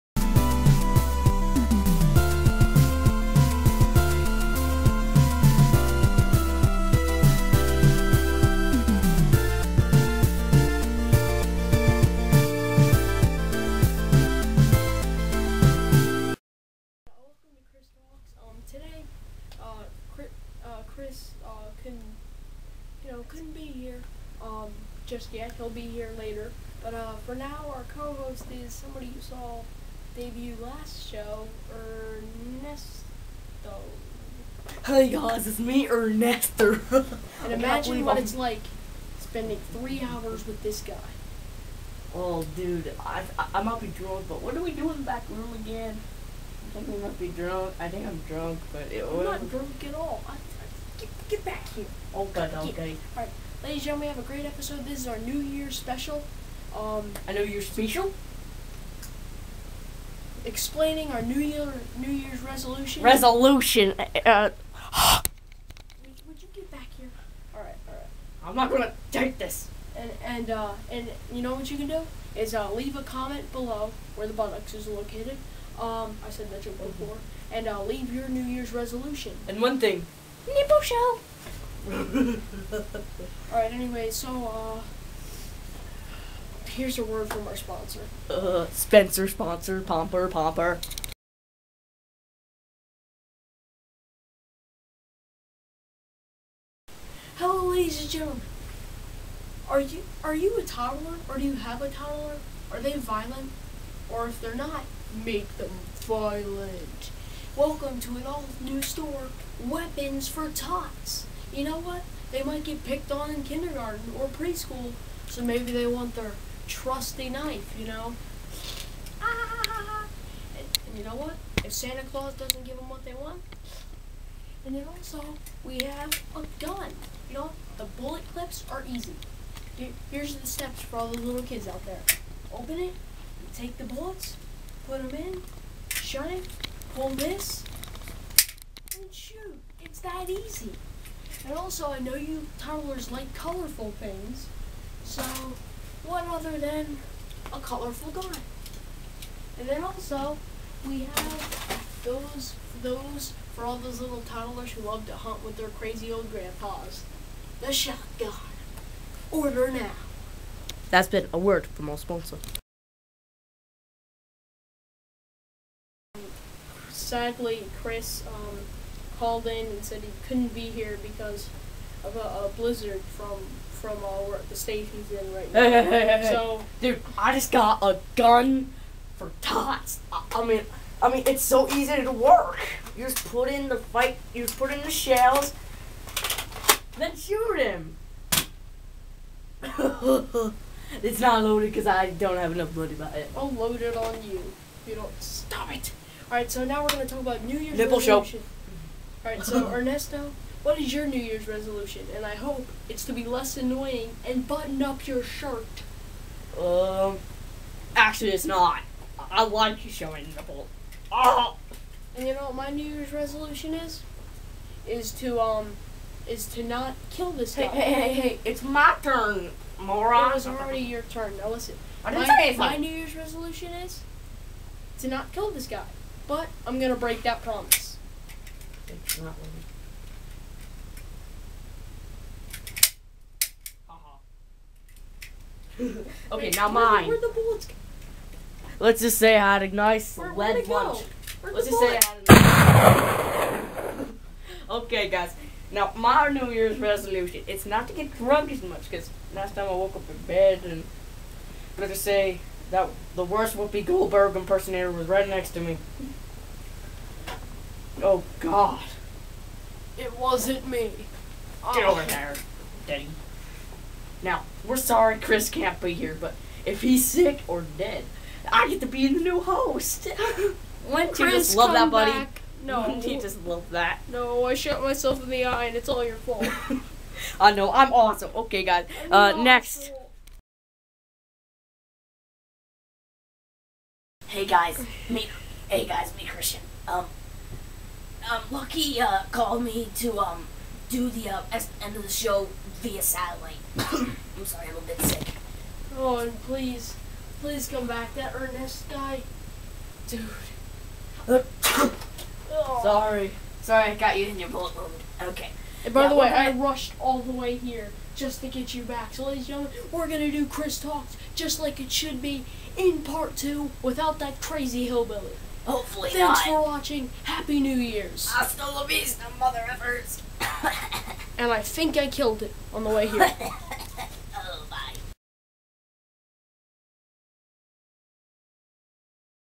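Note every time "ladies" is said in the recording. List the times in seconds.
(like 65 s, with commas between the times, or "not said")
53 s, 97 s, 309 s.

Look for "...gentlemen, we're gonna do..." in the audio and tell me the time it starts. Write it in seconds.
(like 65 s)
309 s.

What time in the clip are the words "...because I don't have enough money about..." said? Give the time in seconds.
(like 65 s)
191 s.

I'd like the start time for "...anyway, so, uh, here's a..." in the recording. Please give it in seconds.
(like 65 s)
83 s.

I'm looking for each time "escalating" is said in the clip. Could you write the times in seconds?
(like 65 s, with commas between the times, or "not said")
not said.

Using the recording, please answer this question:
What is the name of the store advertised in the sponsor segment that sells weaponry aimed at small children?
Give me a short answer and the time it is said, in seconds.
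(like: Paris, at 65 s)
Weapons for Tots, at 109 s.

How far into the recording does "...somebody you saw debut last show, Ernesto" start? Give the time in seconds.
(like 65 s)
28 s.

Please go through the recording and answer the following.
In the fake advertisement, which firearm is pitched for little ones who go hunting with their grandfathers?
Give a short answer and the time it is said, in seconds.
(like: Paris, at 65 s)
The shotgun, at 157 s.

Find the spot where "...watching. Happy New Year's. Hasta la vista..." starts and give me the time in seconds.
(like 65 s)
316 s.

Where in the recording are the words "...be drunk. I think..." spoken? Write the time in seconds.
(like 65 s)
47 s.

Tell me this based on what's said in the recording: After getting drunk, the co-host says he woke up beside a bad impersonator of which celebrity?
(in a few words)
Whoopi Goldberg.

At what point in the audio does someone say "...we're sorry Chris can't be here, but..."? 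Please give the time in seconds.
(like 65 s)
264 s.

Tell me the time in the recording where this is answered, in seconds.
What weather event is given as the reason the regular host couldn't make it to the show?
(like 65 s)
172 s.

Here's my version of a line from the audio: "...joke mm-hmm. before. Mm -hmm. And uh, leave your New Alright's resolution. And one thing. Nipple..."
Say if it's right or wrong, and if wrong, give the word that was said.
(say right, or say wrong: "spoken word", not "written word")
wrong: "Year", not "Alright".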